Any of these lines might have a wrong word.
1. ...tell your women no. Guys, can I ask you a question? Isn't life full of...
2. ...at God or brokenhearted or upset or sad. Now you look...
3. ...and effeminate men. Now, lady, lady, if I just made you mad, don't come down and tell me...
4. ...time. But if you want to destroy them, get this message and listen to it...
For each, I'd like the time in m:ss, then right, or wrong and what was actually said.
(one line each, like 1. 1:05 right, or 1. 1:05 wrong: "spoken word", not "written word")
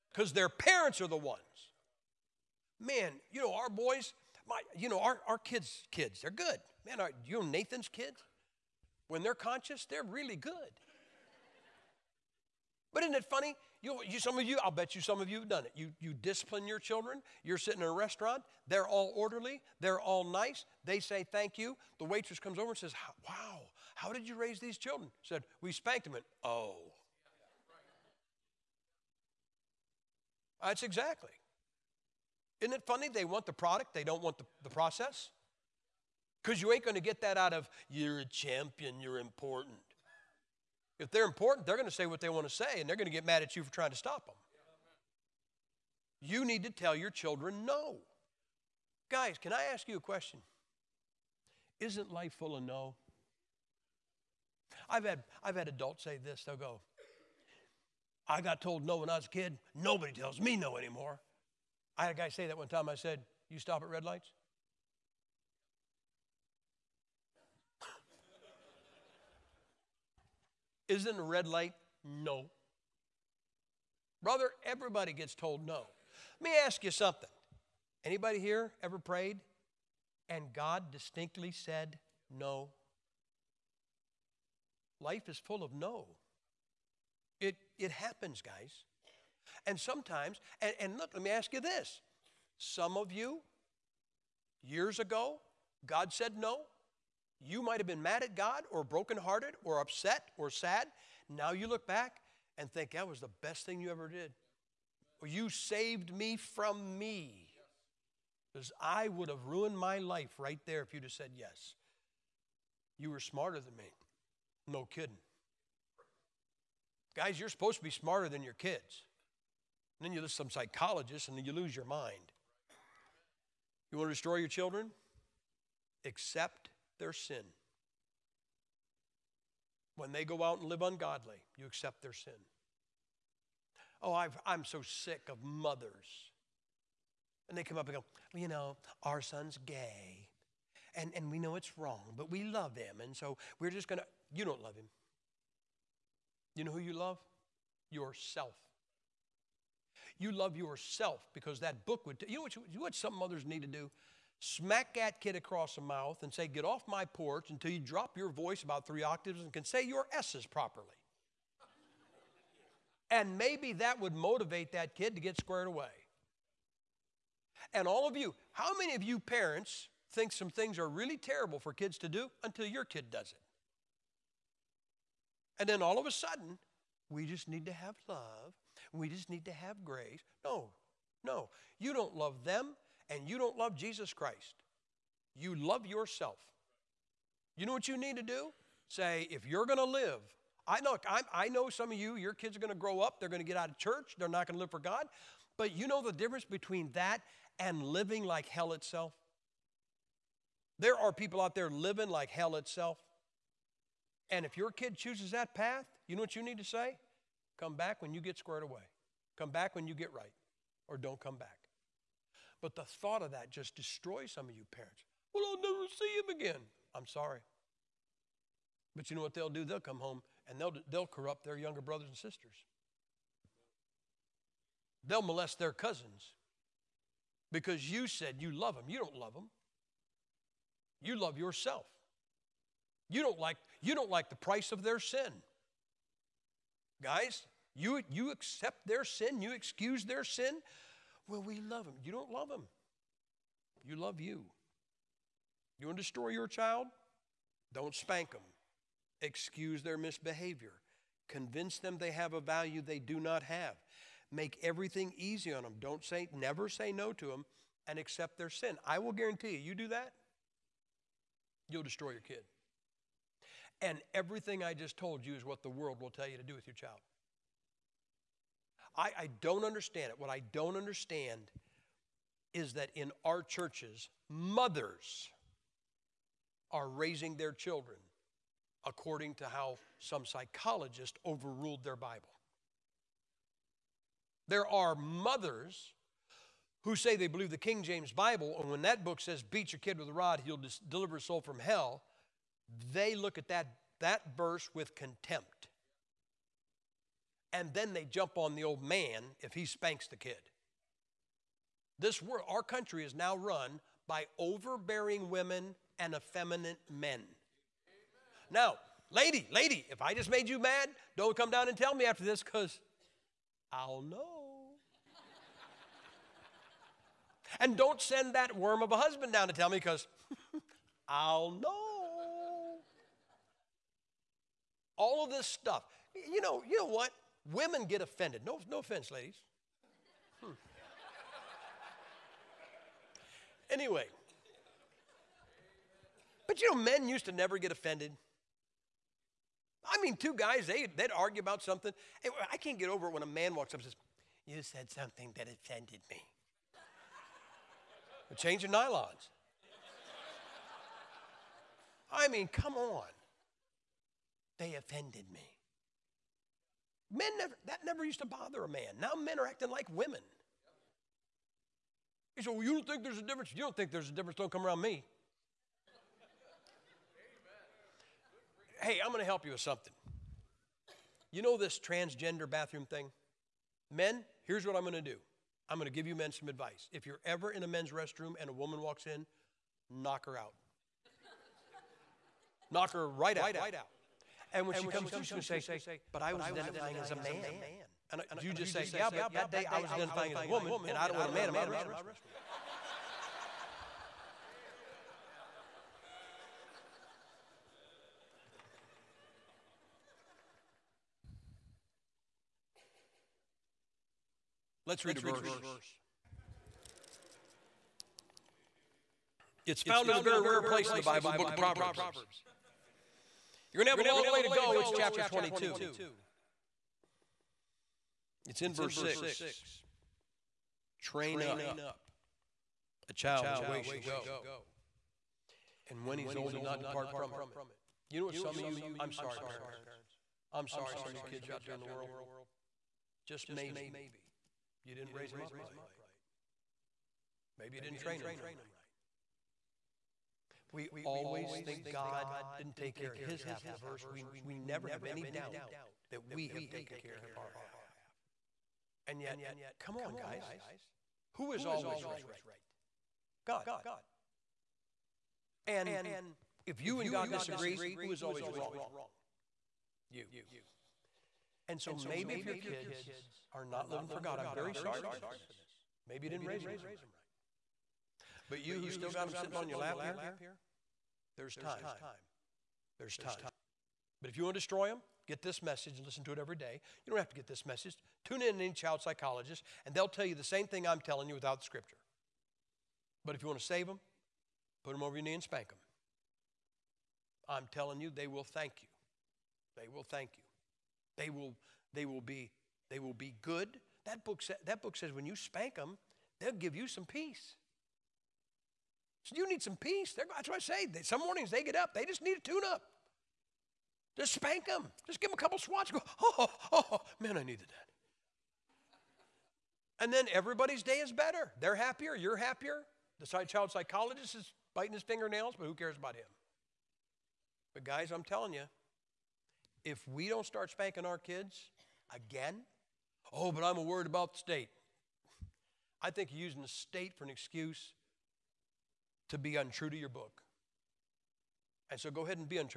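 1. 0:46 wrong: "children", not "women"
2. 1:38 right
3. 5:05 right
4. 7:53 right.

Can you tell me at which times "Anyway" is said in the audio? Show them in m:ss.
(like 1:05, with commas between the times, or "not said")
5:33.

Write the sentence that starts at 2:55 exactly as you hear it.
And then all of a sudden, we just need to have love.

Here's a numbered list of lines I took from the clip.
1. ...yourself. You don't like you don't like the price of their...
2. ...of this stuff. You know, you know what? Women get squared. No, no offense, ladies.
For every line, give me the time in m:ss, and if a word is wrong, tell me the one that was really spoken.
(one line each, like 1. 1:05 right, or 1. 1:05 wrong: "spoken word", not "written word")
1. 3:51 right
2. 5:25 wrong: "offended", not "squared".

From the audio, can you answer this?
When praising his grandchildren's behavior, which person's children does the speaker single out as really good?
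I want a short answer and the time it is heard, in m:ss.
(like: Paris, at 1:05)
Nathan, at 0:07.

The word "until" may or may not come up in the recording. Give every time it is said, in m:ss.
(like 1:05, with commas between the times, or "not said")
2:37, 2:52.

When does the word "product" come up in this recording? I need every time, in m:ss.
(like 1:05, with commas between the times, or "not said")
0:33.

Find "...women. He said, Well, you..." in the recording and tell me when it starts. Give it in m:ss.
5:59.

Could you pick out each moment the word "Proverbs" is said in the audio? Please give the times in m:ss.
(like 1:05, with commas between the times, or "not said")
6:51.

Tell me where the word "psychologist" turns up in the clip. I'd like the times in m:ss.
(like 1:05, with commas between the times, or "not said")
2:00, 4:40, 7:59, 8:33.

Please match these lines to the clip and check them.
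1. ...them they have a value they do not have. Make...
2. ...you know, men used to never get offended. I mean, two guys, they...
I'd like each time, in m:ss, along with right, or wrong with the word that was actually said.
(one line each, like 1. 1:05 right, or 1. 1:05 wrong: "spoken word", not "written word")
1. 4:11 right
2. 5:36 right.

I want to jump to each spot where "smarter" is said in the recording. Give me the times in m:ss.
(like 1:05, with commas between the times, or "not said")
1:53, 1:57.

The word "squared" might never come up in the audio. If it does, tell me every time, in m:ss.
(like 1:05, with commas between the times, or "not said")
2:45, 3:28.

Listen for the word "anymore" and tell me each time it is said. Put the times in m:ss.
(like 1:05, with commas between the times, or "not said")
1:00.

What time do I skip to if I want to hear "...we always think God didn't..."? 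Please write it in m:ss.
7:20.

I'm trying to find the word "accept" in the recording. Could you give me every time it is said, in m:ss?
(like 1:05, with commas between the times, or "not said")
2:06, 2:11, 3:58, 4:17.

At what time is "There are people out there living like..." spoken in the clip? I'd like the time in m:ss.
3:20.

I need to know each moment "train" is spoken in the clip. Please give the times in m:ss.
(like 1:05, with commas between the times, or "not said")
7:01, 7:17.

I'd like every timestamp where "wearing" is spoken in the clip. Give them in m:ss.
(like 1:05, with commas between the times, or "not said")
not said.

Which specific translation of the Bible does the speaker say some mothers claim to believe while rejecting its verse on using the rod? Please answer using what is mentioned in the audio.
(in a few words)
King James Bible.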